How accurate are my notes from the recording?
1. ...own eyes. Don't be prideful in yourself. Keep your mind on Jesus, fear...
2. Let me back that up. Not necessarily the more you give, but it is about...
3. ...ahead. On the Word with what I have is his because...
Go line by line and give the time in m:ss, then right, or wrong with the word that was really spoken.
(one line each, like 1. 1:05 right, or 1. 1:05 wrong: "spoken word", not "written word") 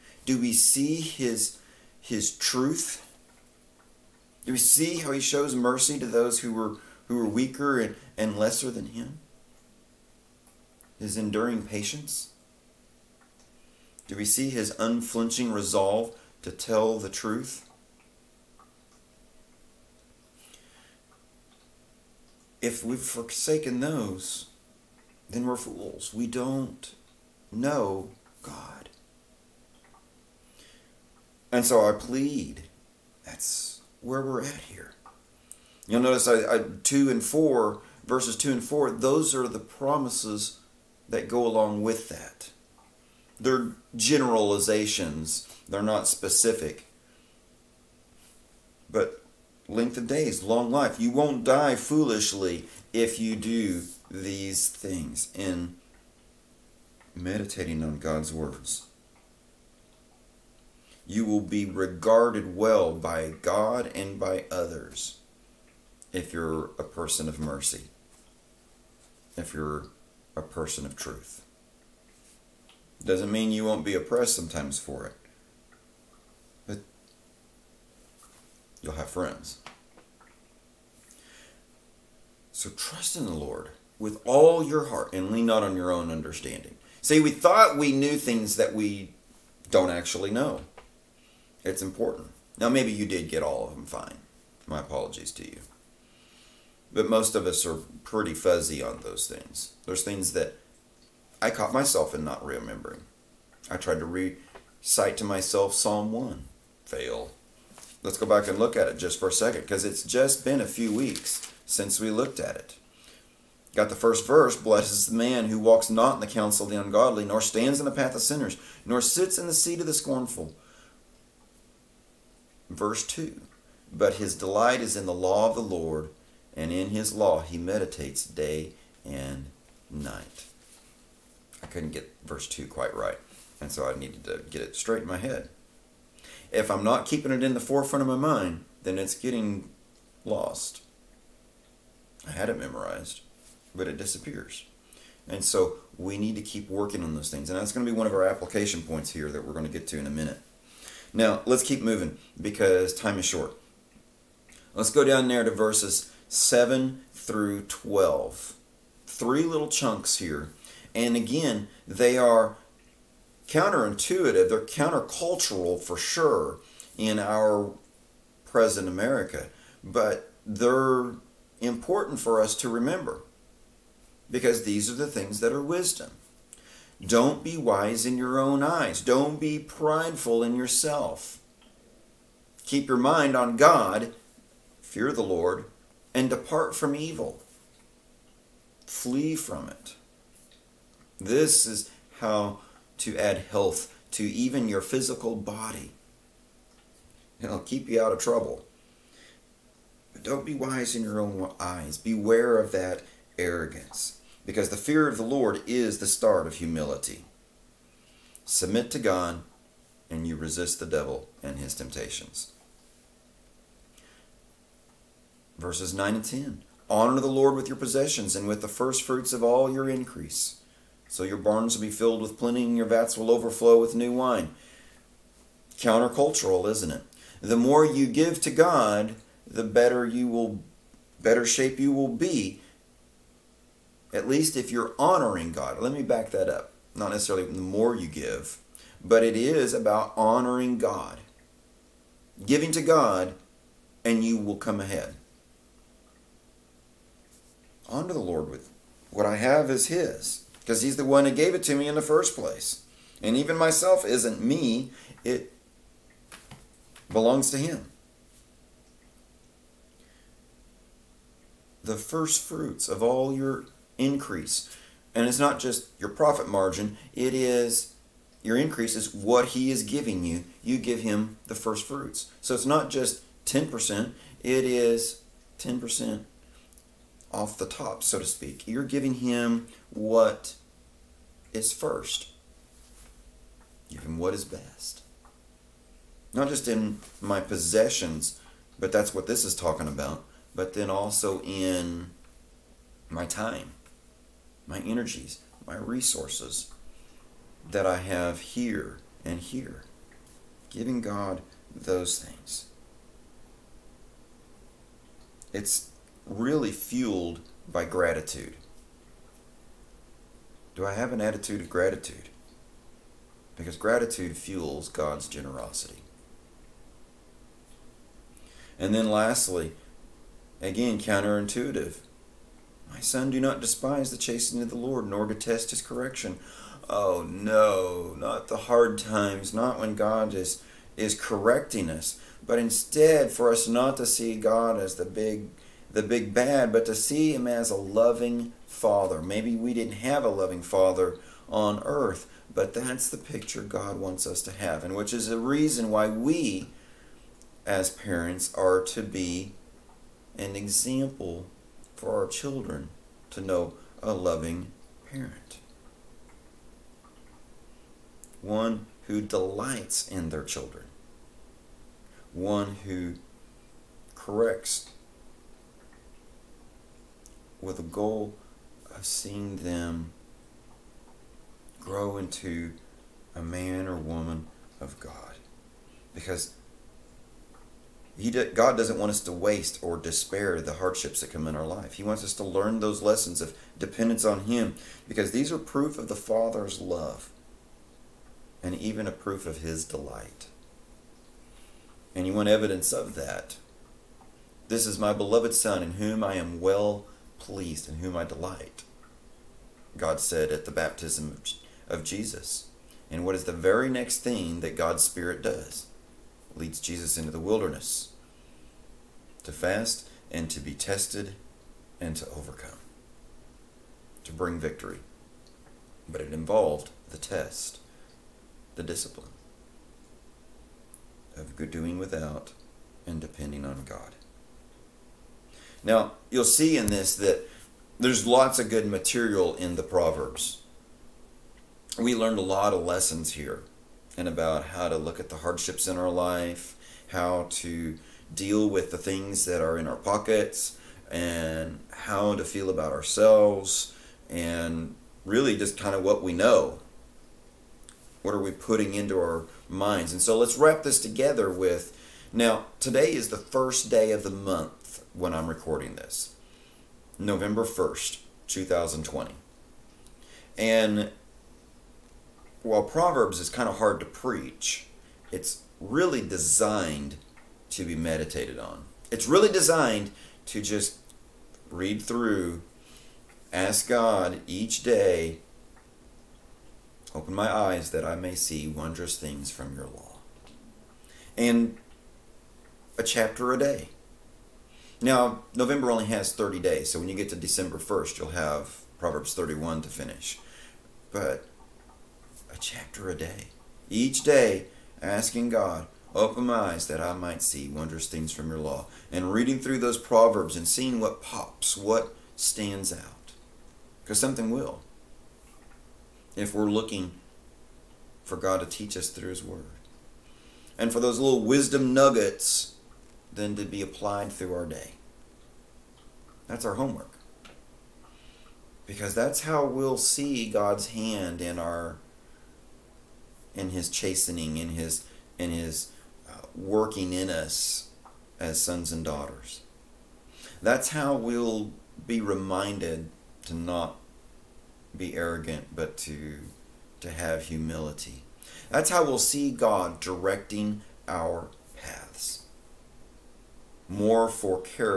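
1. 2:58 wrong: "God", not "Jesus"
2. 3:55 right
3. 4:04 wrong: "Lord", not "Word".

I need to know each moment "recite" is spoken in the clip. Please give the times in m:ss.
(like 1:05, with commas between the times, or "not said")
1:44.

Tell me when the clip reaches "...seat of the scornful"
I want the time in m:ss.
1:59.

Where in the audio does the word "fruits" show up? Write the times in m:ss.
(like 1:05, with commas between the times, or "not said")
3:39, 4:22, 4:31.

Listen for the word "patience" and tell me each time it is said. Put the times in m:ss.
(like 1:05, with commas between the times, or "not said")
0:11.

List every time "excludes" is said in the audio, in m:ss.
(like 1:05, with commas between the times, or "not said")
not said.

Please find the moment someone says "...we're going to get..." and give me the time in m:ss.
2:29.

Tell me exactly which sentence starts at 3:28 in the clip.
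Submit to God, and you resist the devil and his temptations.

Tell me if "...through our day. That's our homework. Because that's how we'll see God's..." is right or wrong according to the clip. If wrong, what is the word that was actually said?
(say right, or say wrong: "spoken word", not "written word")
right.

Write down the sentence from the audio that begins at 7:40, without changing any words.
And while Proverbs is kind of hard to preach, it's really designed to be meditated on.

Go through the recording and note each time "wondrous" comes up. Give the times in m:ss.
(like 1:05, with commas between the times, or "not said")
7:58, 8:17.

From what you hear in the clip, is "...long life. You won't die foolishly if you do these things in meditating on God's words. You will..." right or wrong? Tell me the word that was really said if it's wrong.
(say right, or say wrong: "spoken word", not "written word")
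right.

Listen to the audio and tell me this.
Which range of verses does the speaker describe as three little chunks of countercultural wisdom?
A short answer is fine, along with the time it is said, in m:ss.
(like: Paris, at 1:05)
7 through 12, at 2:35.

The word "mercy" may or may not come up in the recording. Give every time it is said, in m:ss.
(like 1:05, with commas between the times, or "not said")
0:05, 1:07.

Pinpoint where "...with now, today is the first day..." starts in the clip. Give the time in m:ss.
7:31.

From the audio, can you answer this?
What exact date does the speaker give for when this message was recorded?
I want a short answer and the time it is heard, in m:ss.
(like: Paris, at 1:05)
November 1st, 2020, at 7:37.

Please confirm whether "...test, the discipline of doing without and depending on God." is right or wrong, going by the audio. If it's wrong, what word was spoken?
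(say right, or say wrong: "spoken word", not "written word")
right.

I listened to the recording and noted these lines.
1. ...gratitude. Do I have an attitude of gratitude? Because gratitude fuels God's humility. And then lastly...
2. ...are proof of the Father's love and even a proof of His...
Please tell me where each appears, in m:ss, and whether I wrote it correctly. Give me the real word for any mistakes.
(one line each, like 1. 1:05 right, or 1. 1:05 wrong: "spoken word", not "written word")
1. 5:07 wrong: "generosity", not "humility"
2. 6:25 right.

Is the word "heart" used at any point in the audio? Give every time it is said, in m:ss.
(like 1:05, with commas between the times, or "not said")
1:24.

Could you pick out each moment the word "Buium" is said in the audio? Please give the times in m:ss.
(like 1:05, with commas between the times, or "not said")
not said.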